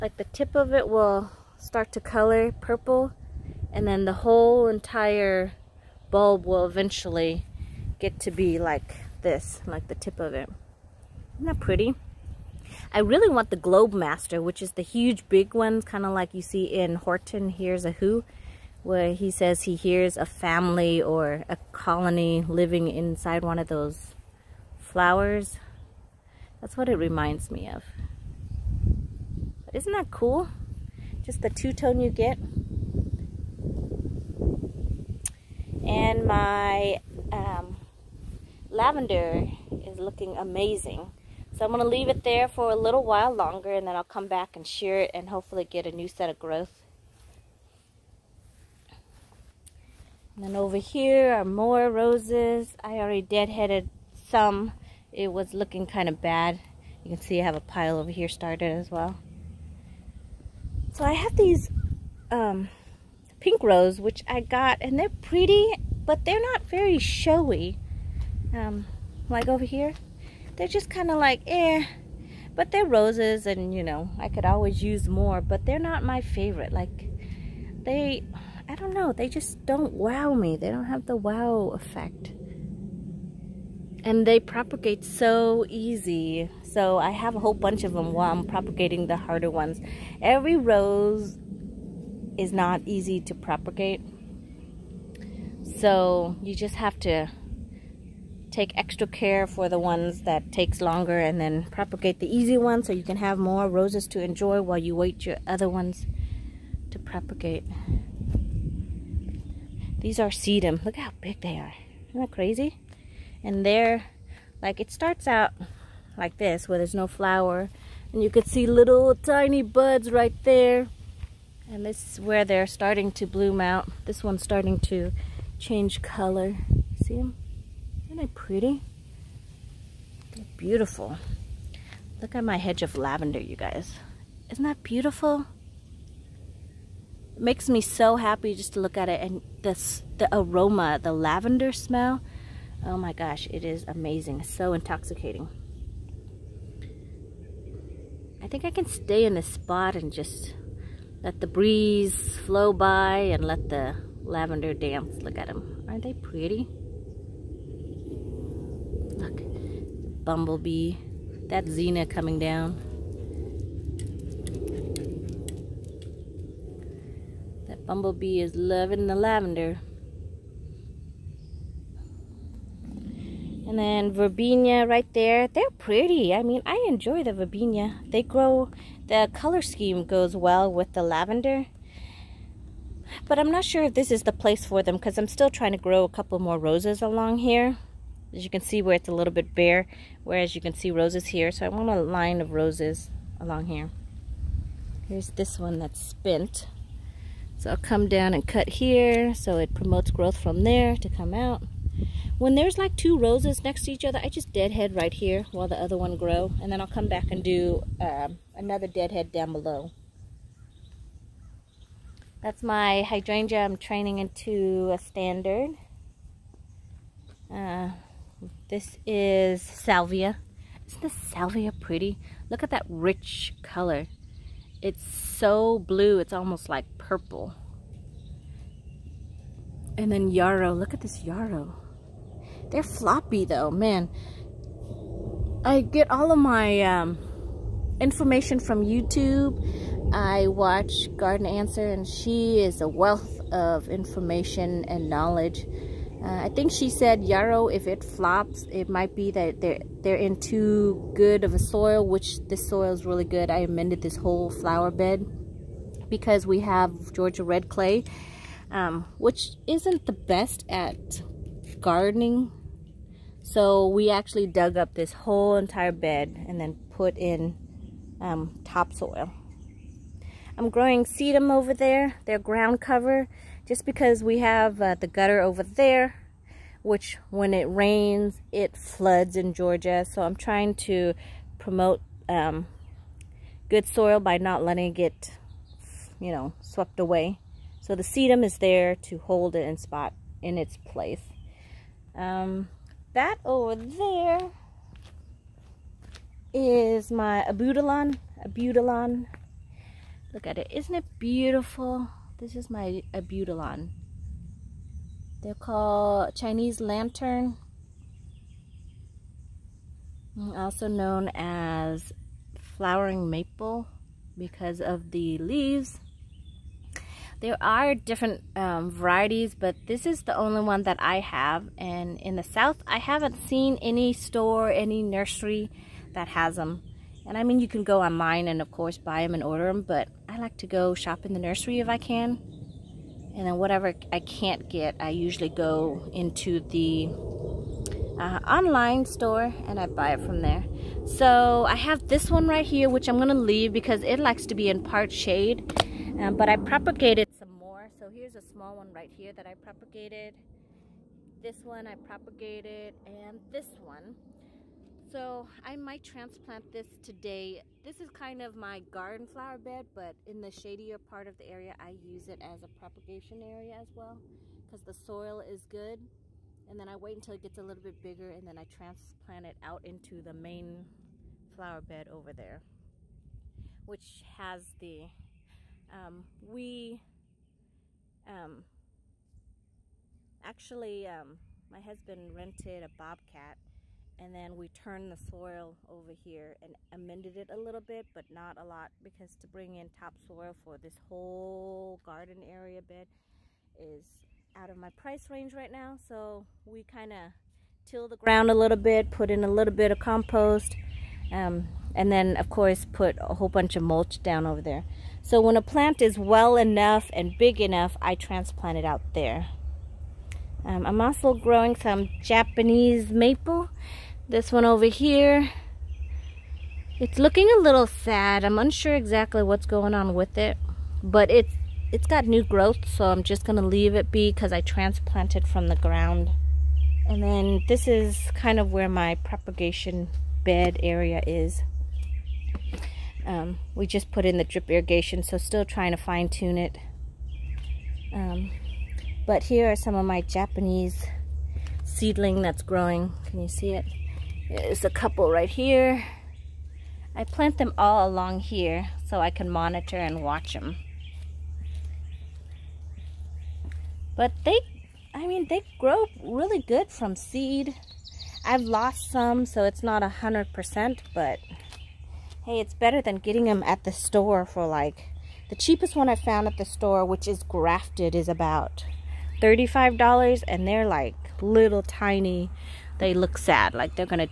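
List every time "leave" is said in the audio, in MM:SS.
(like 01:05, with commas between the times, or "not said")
00:41, 05:15, 05:43, 07:03.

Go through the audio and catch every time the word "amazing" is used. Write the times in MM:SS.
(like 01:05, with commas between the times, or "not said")
00:40, 02:23.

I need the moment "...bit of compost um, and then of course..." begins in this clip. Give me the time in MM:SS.
06:39.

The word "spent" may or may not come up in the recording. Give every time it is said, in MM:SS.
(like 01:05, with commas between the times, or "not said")
03:16.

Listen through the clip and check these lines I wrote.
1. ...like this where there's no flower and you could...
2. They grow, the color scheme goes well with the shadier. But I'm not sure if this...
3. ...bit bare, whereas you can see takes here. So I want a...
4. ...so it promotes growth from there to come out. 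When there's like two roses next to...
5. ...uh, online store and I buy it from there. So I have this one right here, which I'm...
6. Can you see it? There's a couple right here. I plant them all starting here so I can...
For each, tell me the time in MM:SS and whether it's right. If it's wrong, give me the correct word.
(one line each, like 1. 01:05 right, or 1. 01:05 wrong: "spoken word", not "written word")
1. 01:56 right
2. 02:58 wrong: "lavender", not "shadier"
3. 03:09 wrong: "roses", not "takes"
4. 03:19 right
5. 05:38 right
6. 07:23 wrong: "along", not "starting".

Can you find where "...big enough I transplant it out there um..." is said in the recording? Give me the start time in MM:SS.
06:47.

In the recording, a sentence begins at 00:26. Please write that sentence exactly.
That's what it reminds me of.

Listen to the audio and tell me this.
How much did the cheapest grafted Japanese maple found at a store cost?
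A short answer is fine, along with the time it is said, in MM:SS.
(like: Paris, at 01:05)
$35, at 07:49.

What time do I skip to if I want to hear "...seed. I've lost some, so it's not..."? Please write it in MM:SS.
07:37.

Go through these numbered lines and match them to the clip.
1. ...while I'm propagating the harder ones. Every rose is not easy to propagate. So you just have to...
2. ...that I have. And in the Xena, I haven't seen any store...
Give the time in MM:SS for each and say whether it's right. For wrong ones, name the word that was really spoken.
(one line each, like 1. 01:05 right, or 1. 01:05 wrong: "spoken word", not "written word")
1. 01:28 right
2. 05:20 wrong: "South", not "Xena".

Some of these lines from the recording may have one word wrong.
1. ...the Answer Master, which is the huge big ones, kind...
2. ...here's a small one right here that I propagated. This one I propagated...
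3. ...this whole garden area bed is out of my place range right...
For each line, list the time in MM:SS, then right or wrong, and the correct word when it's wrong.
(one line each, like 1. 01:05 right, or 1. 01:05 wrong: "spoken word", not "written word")
1. 00:13 wrong: "Globe", not "Answer"
2. 05:48 right
3. 06:30 wrong: "price", not "place".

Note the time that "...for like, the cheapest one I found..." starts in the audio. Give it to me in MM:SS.
07:44.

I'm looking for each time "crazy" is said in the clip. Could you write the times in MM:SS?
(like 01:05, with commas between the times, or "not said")
01:52.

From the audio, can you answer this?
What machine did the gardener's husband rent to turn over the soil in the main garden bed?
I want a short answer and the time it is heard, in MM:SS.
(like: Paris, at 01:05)
bobcat, at 06:22.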